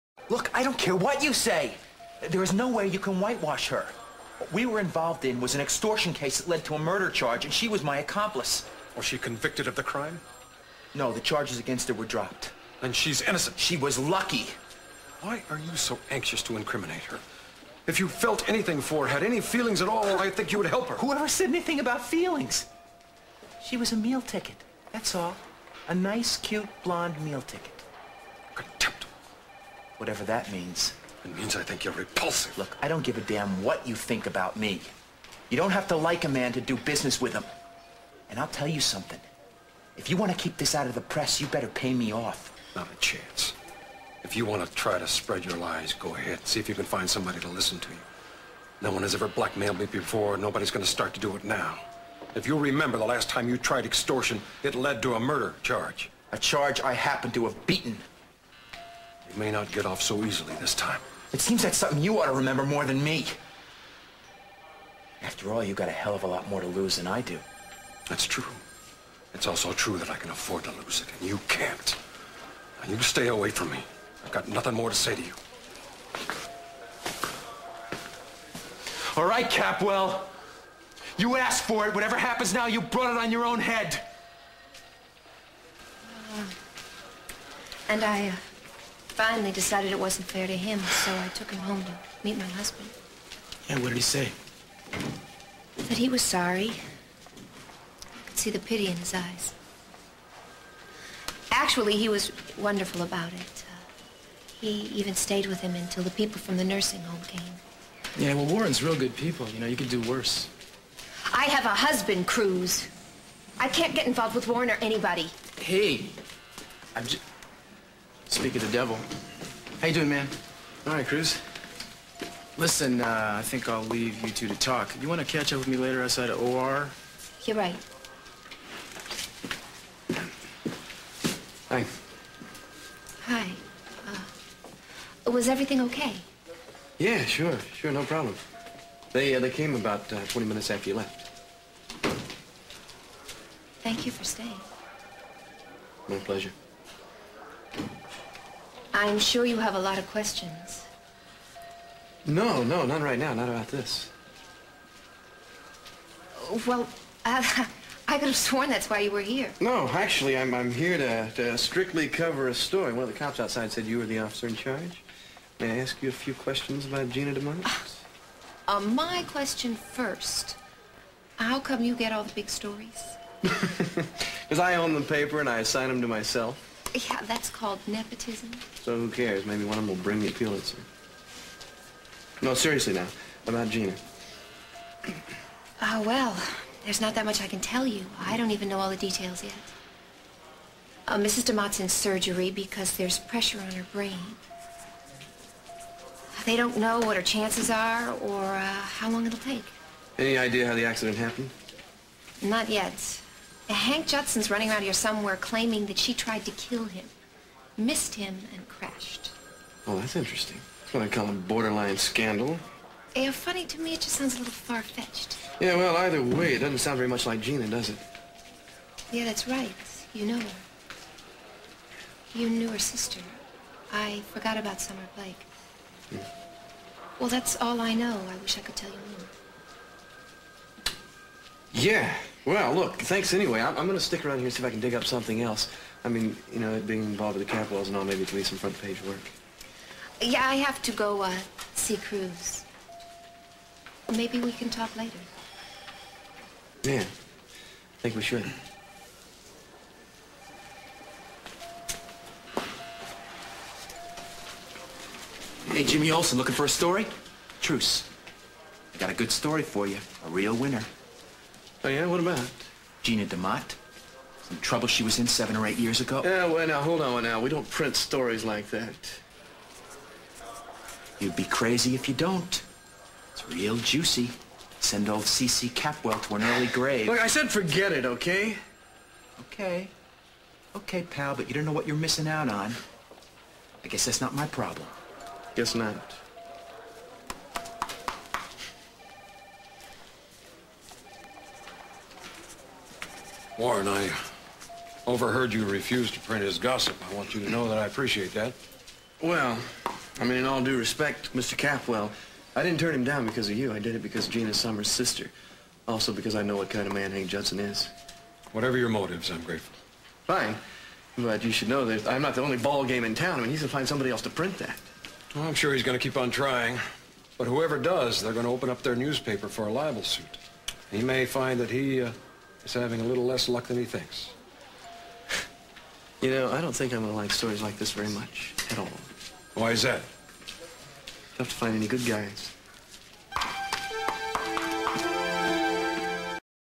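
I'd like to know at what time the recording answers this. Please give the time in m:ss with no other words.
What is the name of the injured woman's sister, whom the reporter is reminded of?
3:44.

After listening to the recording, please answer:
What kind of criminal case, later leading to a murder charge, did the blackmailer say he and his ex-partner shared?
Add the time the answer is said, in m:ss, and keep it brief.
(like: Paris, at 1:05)
extortion case, at 0:05.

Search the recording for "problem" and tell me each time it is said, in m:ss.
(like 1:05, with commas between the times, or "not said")
2:18, 4:44.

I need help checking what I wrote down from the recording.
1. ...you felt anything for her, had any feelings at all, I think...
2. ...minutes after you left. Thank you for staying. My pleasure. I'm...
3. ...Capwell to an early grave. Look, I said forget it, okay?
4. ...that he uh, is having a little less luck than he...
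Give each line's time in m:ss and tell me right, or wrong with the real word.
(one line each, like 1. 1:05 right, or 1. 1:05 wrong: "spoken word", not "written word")
1. 0:17 right
2. 2:20 right
3. 4:35 right
4. 5:21 right.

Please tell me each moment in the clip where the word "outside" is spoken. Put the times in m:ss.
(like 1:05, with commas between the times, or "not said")
2:06, 2:43.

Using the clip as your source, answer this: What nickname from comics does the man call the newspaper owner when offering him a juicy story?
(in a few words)
Jimmy Olsen.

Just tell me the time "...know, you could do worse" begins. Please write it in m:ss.
1:49.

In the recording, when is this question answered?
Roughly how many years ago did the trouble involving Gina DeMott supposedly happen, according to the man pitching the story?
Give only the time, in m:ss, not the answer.
4:25.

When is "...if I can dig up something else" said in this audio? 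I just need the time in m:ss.
3:54.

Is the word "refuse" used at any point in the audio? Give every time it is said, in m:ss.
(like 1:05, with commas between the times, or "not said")
4:55.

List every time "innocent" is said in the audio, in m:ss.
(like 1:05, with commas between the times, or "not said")
0:13.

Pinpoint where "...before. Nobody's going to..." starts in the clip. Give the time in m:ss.
0:49.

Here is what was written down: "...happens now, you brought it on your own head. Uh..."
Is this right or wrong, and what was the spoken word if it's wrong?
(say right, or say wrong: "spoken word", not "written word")
right.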